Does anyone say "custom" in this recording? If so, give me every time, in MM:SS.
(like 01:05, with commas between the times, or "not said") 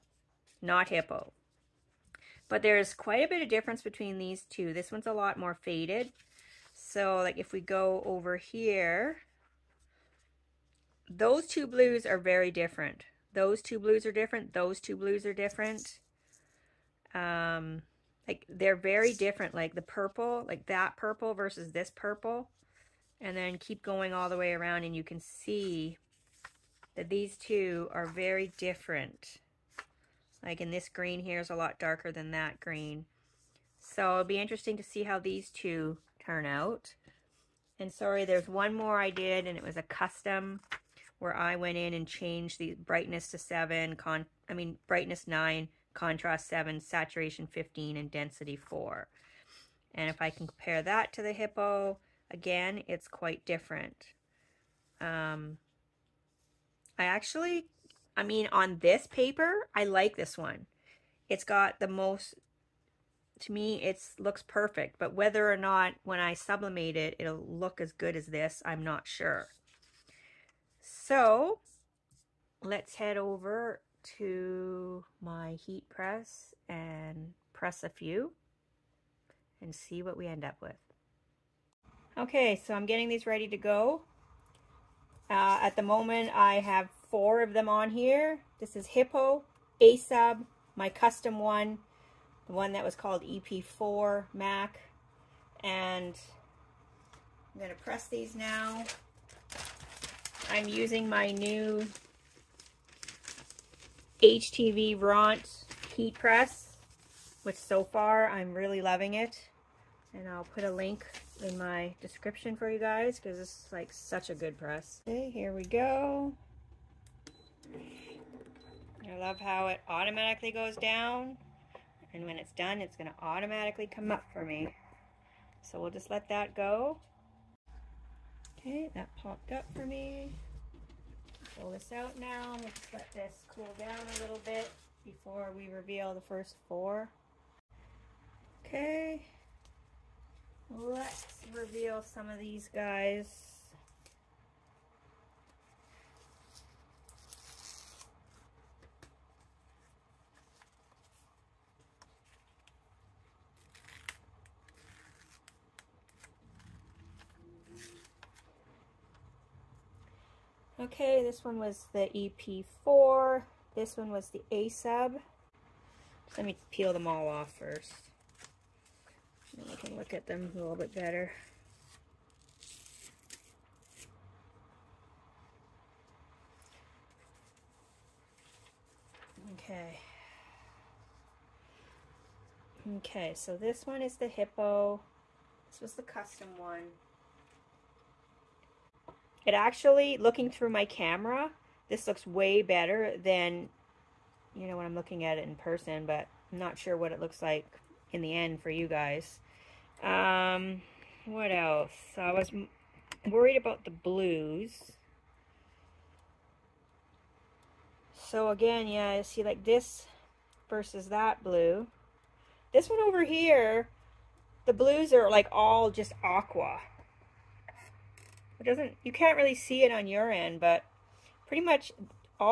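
00:39, 01:30, 03:06.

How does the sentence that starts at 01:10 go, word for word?
So let's head over to my heat press and press a few and see what we end up with.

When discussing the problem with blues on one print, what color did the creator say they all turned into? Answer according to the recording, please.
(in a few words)
aqua.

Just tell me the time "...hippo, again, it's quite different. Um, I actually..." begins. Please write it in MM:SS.
00:51.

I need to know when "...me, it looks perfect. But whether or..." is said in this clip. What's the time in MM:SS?
01:03.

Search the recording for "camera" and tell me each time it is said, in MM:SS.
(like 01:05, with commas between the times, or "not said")
03:10.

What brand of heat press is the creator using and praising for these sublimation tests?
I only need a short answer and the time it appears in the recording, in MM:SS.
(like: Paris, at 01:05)
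HTVRONT, at 01:44.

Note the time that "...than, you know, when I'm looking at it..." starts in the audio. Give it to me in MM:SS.
03:13.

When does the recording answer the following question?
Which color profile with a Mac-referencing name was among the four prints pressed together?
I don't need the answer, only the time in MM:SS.
01:33.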